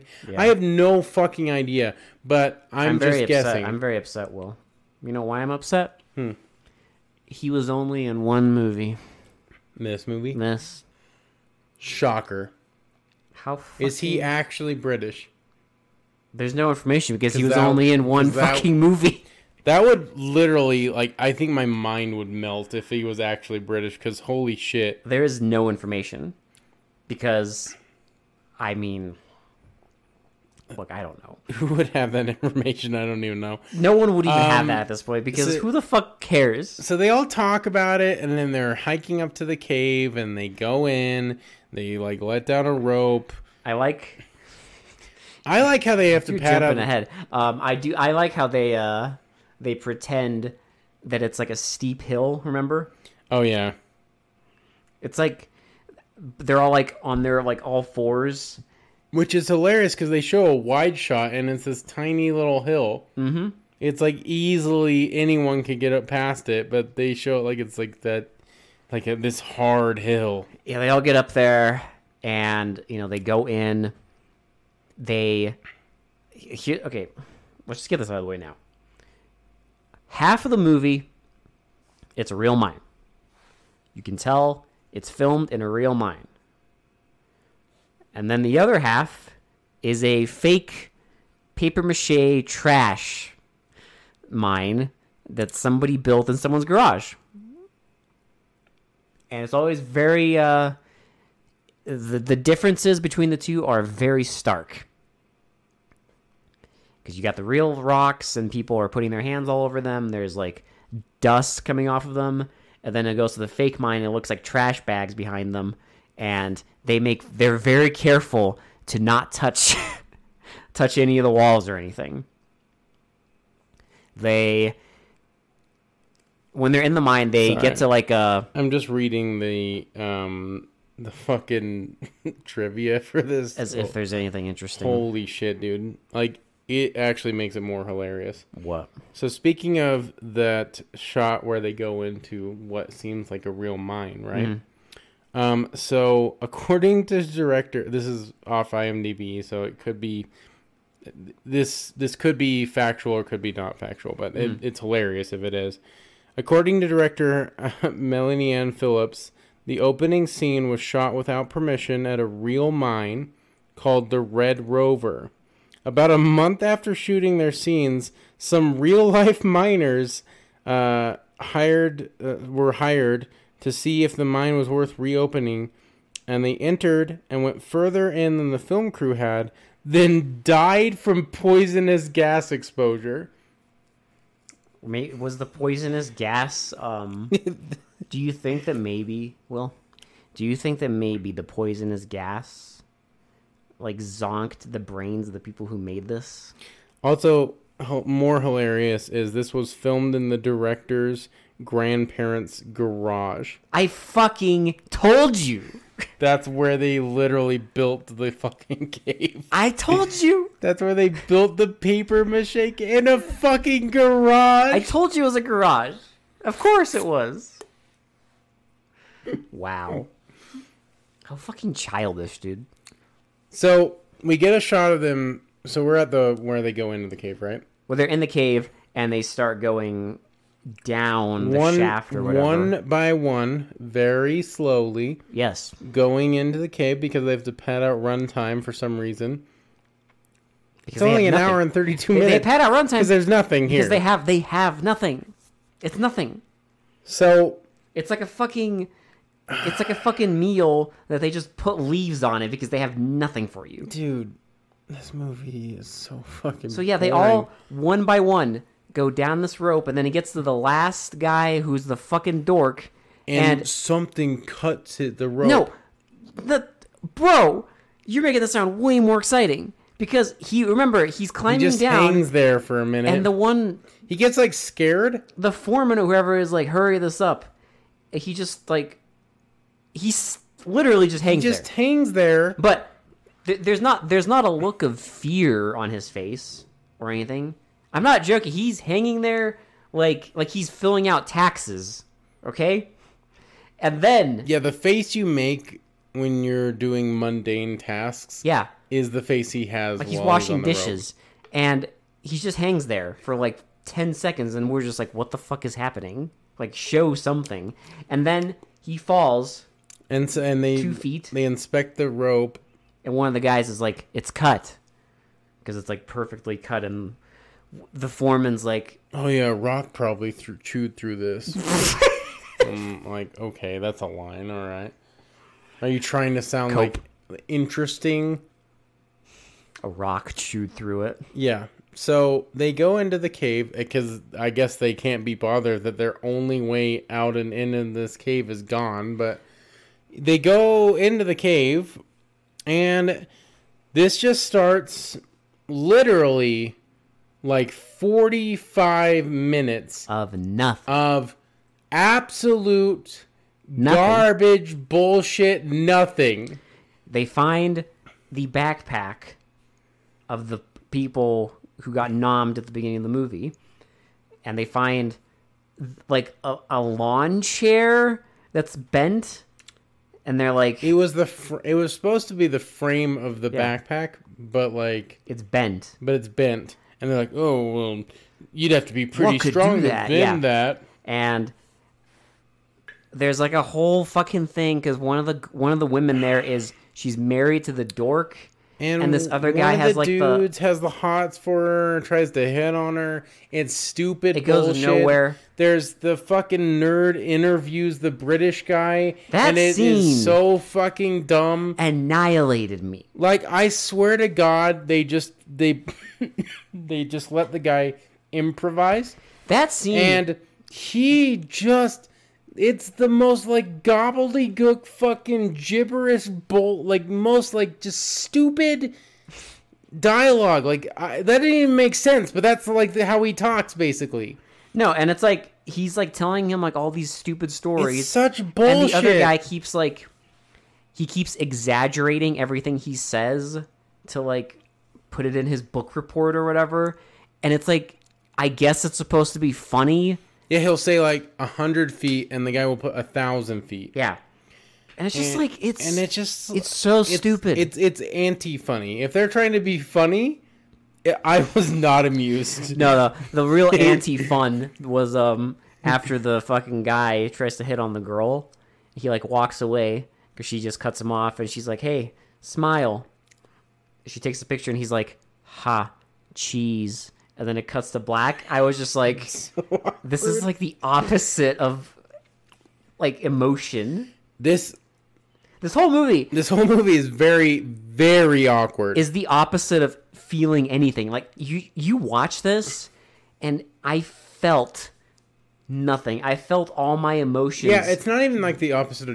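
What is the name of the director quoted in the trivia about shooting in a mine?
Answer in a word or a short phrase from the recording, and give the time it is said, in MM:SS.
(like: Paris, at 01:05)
Melanie Anne Phillips, at 02:37.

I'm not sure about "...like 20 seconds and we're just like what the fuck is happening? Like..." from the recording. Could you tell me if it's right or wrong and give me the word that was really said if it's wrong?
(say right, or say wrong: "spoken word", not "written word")
wrong: "10", not "20".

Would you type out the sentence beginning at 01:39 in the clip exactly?
And it's always very uh, the the differences between the two are very stark.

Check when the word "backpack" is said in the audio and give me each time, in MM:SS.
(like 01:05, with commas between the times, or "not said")
05:58, 06:13.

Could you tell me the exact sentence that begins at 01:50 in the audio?
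There's like dust coming off of them.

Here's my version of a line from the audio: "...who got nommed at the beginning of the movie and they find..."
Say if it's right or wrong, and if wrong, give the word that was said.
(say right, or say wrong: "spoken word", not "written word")
right.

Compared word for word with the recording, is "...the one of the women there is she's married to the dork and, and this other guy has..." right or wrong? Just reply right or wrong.
right.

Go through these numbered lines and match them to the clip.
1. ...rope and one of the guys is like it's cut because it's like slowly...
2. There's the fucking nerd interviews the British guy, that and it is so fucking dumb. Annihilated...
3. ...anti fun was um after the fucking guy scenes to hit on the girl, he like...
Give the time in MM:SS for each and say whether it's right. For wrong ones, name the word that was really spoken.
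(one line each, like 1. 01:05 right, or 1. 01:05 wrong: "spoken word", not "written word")
1. 05:12 wrong: "perfectly", not "slowly"
2. 06:35 right
3. 07:33 wrong: "tries", not "scenes".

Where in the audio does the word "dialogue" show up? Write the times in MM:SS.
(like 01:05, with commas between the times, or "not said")
06:59.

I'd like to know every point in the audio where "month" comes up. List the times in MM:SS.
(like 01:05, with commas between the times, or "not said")
02:46.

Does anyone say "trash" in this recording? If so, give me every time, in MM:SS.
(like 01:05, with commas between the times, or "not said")
01:32, 01:54.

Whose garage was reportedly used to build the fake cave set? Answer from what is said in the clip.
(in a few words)
Director's grandparents'.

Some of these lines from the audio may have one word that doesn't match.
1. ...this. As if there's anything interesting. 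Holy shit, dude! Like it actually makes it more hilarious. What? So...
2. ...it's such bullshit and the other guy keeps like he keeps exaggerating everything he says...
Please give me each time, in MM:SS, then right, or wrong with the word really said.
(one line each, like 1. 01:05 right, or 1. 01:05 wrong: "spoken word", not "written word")
1. 02:13 right
2. 07:08 right.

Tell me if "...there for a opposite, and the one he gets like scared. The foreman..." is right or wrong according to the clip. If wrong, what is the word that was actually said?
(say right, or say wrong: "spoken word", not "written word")
wrong: "minute", not "opposite".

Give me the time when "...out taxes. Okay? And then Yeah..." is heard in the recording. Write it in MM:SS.
04:51.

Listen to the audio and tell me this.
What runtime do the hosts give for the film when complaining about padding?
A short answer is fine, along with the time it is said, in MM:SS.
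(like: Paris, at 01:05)
1 hour 32 minutes, at 04:01.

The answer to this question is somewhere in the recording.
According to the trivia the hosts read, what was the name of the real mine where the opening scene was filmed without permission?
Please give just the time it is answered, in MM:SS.
02:44.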